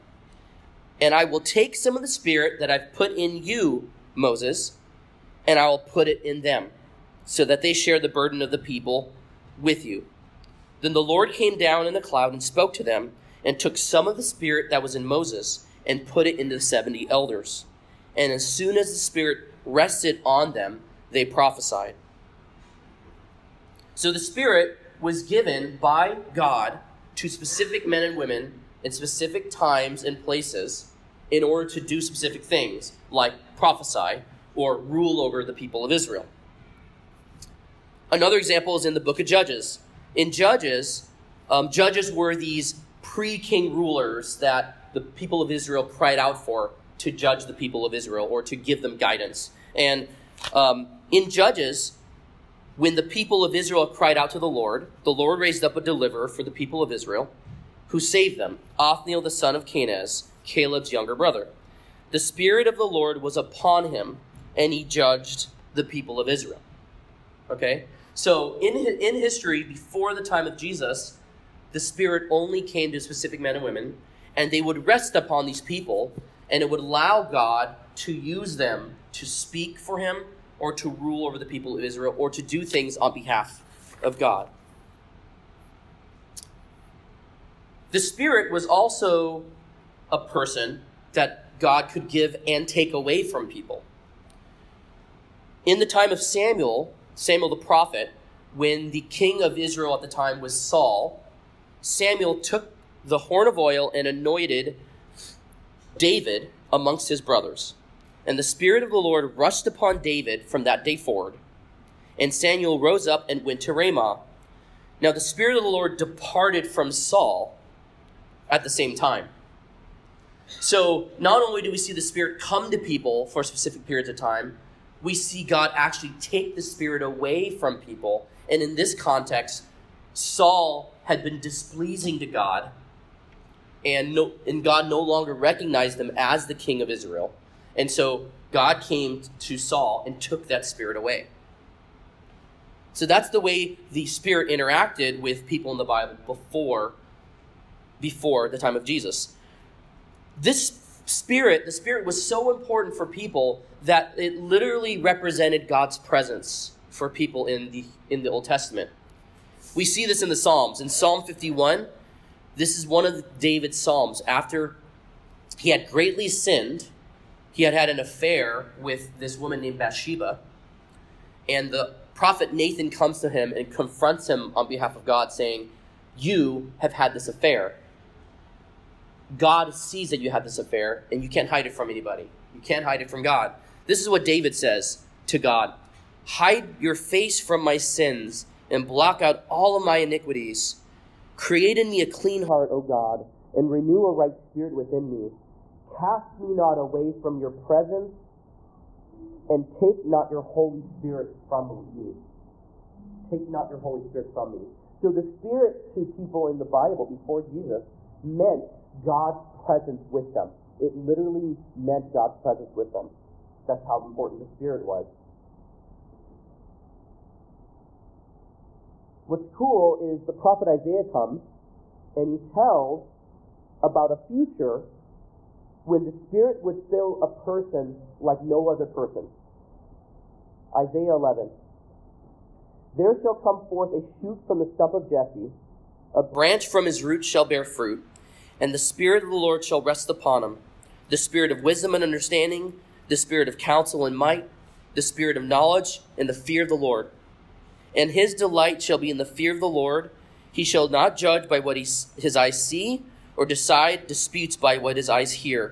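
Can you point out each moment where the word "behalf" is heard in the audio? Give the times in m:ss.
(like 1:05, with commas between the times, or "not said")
1:23, 2:54.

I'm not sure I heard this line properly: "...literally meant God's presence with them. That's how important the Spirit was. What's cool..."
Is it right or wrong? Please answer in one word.
right.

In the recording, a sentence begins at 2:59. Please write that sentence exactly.
God sees that you had this affair and you can't hide it from anybody.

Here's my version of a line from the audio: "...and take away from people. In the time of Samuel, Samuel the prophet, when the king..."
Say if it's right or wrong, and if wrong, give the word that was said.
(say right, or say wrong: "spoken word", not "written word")
right.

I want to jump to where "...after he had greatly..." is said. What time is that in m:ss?
2:44.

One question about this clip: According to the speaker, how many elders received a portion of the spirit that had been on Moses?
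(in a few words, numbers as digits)
70.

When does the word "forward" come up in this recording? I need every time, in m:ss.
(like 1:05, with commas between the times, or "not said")
1:50.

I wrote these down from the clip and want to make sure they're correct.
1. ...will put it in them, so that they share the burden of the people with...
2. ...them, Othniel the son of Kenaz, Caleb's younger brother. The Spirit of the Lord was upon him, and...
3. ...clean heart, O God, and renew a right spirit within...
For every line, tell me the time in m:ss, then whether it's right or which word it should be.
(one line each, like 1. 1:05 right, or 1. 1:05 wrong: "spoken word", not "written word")
1. 0:05 right
2. 0:58 right
3. 3:12 right.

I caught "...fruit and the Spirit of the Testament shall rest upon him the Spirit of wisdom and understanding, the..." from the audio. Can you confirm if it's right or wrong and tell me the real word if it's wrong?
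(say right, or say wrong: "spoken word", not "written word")
wrong: "Lord", not "Testament".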